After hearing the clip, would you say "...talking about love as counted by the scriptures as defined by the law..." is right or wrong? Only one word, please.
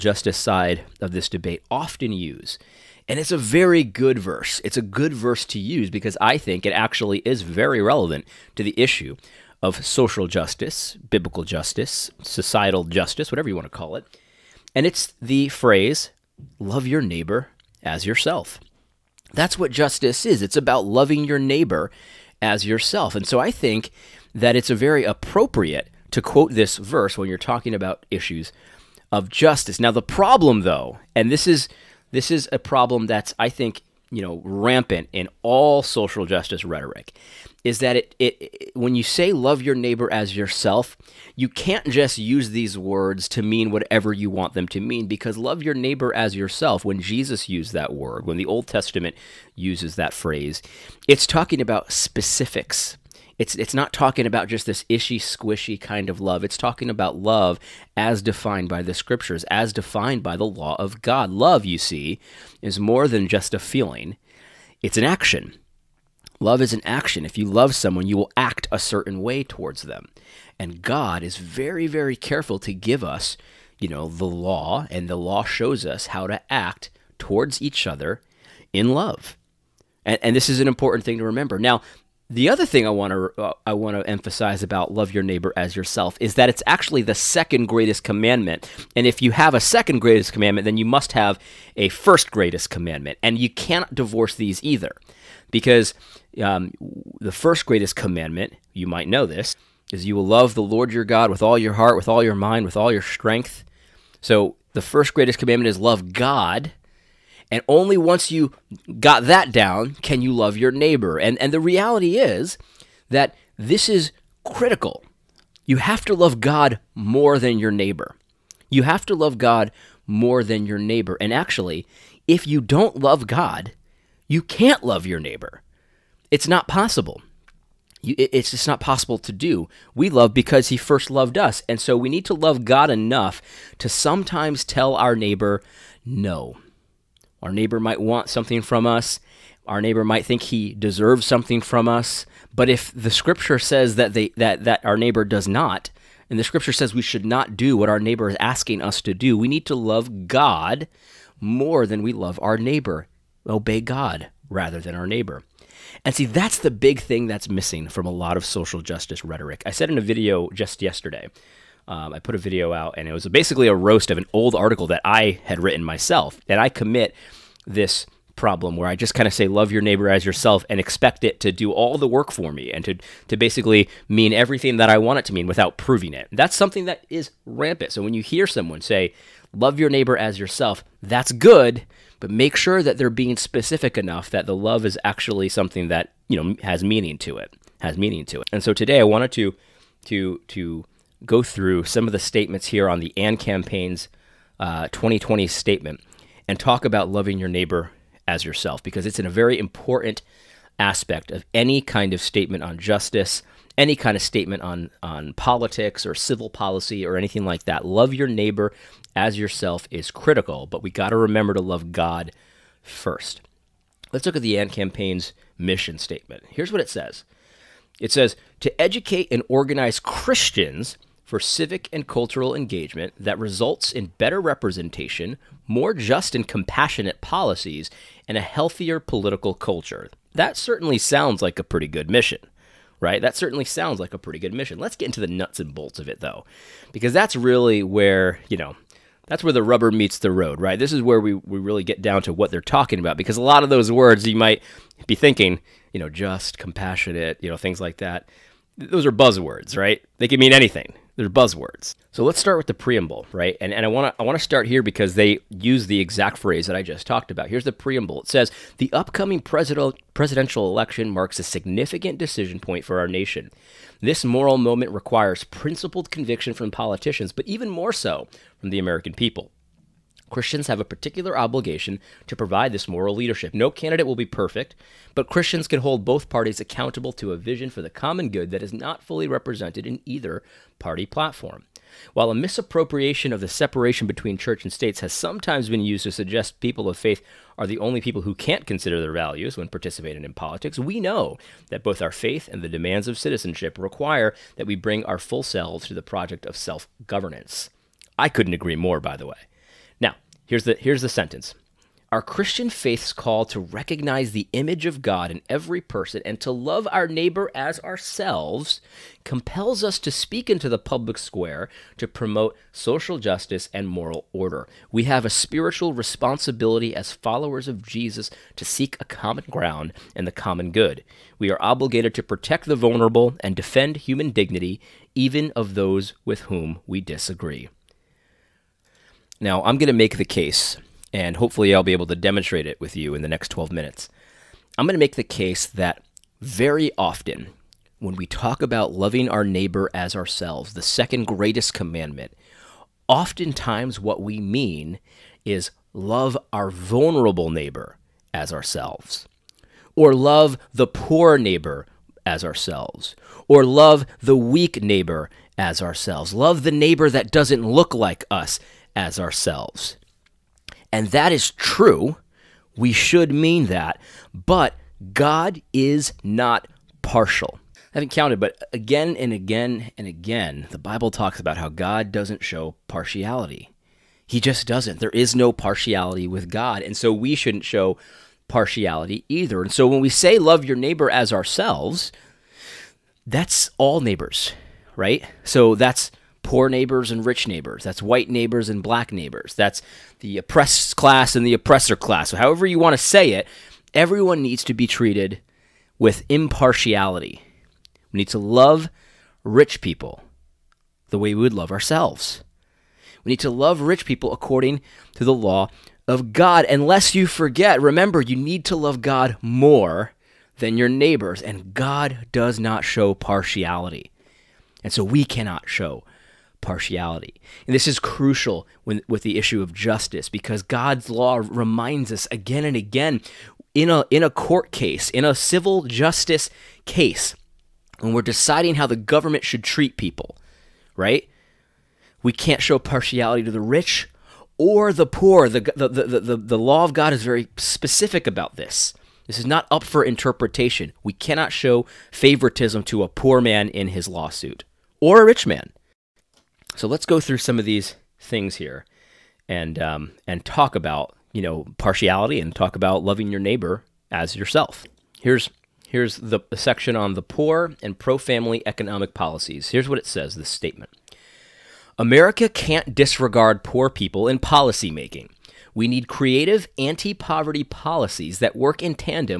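wrong.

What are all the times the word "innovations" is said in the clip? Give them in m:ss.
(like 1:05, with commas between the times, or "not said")
not said.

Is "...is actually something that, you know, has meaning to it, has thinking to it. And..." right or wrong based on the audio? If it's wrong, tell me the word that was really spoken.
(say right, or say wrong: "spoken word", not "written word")
wrong: "meaning", not "thinking".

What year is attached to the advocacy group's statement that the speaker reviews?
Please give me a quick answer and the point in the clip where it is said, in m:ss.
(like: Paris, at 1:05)
2020, at 3:14.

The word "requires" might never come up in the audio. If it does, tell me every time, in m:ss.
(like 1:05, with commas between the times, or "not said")
4:24, 4:53.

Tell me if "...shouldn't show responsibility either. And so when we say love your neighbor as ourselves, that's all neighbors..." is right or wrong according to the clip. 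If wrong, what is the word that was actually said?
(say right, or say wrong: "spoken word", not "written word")
wrong: "partiality", not "responsibility".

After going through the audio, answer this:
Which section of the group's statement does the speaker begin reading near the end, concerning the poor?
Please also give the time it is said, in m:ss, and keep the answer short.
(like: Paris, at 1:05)
Poor and pro-family economic policies, at 7:37.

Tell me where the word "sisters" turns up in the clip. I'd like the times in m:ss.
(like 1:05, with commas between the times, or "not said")
not said.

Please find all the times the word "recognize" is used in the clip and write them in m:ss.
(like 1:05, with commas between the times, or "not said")
5:03.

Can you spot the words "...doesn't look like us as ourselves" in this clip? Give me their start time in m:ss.
5:57.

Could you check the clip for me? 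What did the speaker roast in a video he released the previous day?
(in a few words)
An old article.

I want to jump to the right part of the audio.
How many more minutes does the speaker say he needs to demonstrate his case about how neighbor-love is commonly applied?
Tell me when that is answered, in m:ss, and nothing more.
5:33.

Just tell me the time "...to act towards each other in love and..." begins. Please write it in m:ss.
1:16.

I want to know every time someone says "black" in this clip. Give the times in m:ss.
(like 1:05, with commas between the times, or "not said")
6:28.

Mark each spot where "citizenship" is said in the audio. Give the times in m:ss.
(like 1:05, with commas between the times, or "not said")
4:53.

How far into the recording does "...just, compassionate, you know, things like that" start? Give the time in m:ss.
4:06.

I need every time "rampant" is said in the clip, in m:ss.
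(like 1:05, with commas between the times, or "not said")
0:34, 2:57.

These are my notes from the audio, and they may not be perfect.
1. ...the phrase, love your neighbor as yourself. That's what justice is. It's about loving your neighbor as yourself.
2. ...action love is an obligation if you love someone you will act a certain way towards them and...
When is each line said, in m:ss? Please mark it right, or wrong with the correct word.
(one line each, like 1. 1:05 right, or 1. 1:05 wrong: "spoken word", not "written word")
1. 0:15 right
2. 1:05 wrong: "action", not "obligation".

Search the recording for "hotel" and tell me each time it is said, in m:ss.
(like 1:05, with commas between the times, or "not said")
not said.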